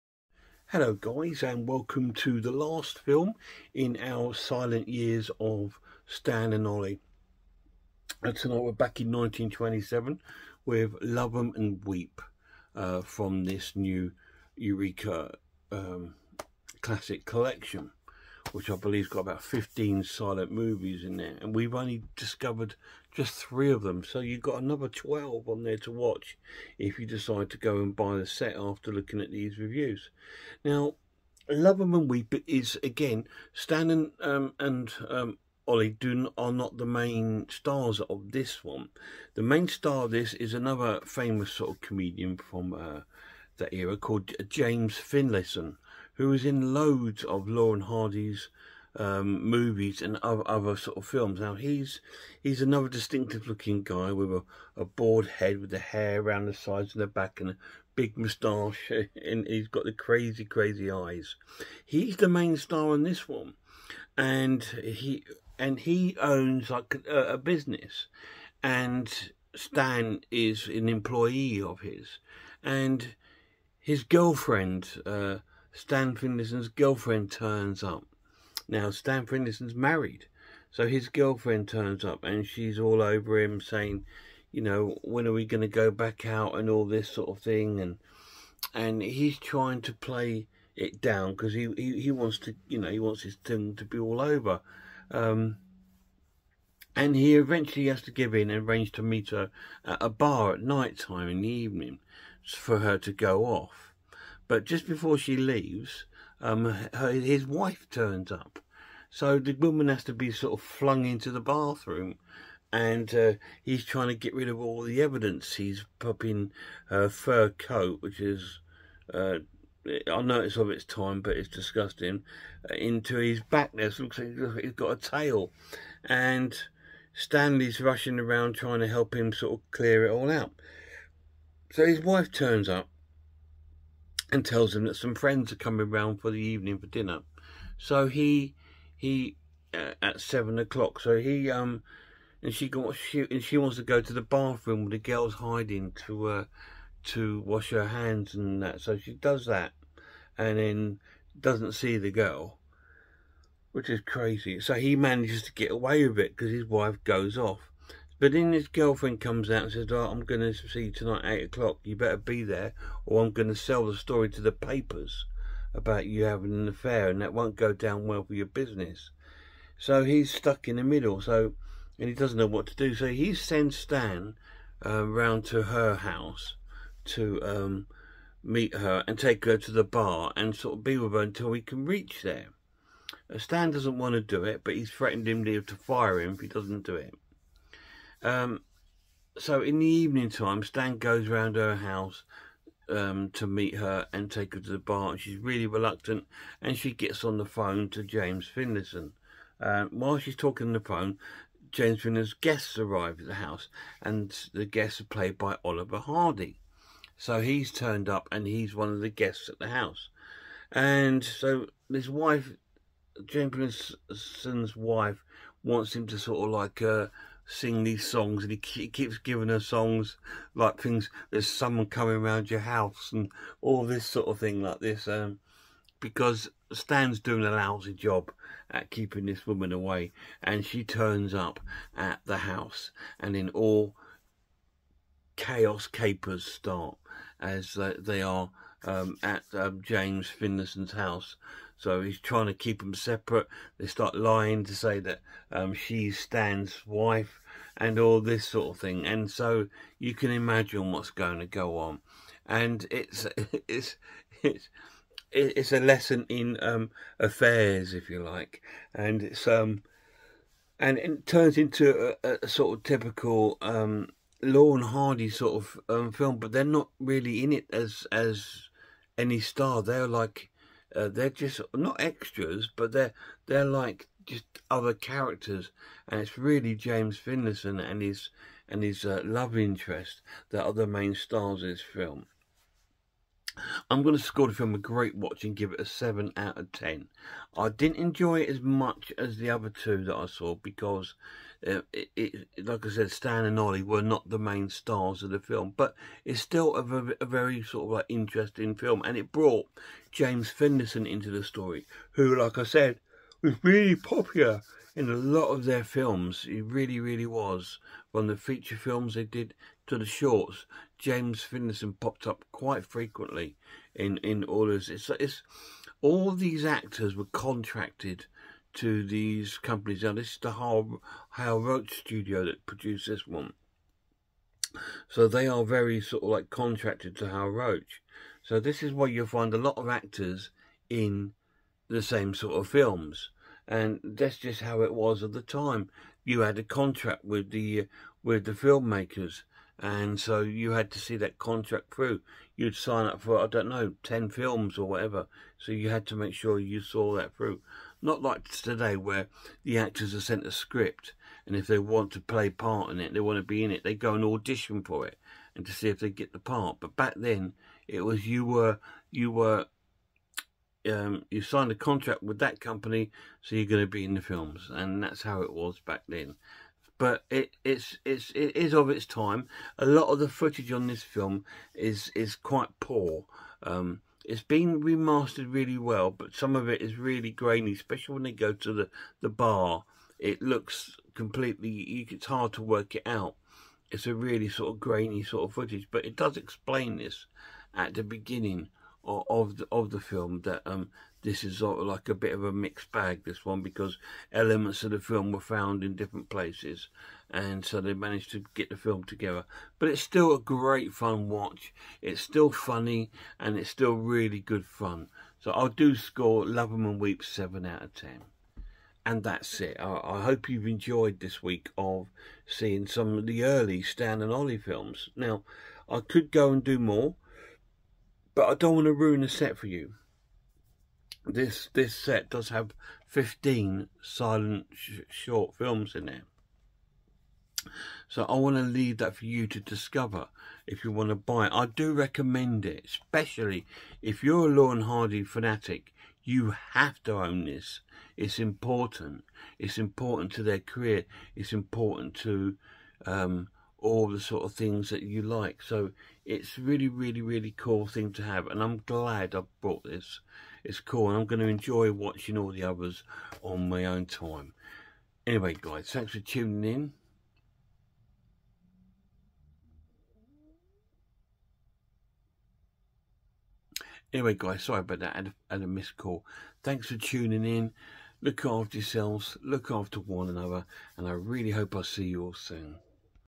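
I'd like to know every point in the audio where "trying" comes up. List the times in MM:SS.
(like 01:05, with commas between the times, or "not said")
01:29, 01:53, 02:08, 04:02.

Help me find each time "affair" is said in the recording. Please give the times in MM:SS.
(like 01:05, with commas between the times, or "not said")
02:46, 04:17.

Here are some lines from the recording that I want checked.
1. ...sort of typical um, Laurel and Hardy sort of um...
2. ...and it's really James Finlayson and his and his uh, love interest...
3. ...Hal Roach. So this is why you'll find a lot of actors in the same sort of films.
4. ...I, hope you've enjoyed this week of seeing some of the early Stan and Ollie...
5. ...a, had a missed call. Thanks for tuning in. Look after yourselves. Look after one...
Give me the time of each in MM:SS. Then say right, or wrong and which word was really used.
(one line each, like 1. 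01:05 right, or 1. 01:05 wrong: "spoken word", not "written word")
1. 04:22 right
2. 04:36 right
3. 05:27 right
4. 06:50 right
5. 07:45 right.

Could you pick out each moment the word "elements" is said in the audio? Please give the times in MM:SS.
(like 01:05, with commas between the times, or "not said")
06:34.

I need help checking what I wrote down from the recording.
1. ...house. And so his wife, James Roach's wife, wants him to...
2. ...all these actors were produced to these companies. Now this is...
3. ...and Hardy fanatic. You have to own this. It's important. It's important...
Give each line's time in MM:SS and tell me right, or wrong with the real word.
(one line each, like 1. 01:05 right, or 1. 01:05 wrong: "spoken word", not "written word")
1. 03:29 wrong: "Finlayson", not "Roach"
2. 05:16 wrong: "contracted", not "produced"
3. 07:14 right.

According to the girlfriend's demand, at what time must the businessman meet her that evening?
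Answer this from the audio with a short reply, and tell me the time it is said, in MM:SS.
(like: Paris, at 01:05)
8 o'clock, at 02:41.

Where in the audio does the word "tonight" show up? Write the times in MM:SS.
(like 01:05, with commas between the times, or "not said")
00:08, 02:40.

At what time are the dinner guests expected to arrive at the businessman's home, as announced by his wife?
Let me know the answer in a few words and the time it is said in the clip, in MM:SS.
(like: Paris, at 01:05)
7 o'clock, at 02:20.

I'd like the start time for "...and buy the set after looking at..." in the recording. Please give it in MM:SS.
00:27.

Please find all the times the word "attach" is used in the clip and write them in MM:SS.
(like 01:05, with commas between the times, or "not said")
not said.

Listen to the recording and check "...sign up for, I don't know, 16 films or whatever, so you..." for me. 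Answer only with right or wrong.
wrong.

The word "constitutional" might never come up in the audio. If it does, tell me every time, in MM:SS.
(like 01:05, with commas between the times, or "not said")
not said.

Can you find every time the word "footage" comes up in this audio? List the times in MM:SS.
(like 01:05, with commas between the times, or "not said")
06:10, 06:25.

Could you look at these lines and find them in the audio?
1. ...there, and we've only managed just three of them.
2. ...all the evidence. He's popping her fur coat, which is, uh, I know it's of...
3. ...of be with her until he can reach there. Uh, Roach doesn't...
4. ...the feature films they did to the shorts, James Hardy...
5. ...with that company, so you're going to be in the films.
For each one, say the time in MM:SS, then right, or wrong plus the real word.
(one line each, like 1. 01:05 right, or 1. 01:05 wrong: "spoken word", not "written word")
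1. 00:21 wrong: "discovered", not "managed"
2. 01:54 right
3. 03:00 wrong: "Stan", not "Roach"
4. 05:08 wrong: "Finlayson", not "Hardy"
5. 06:02 right.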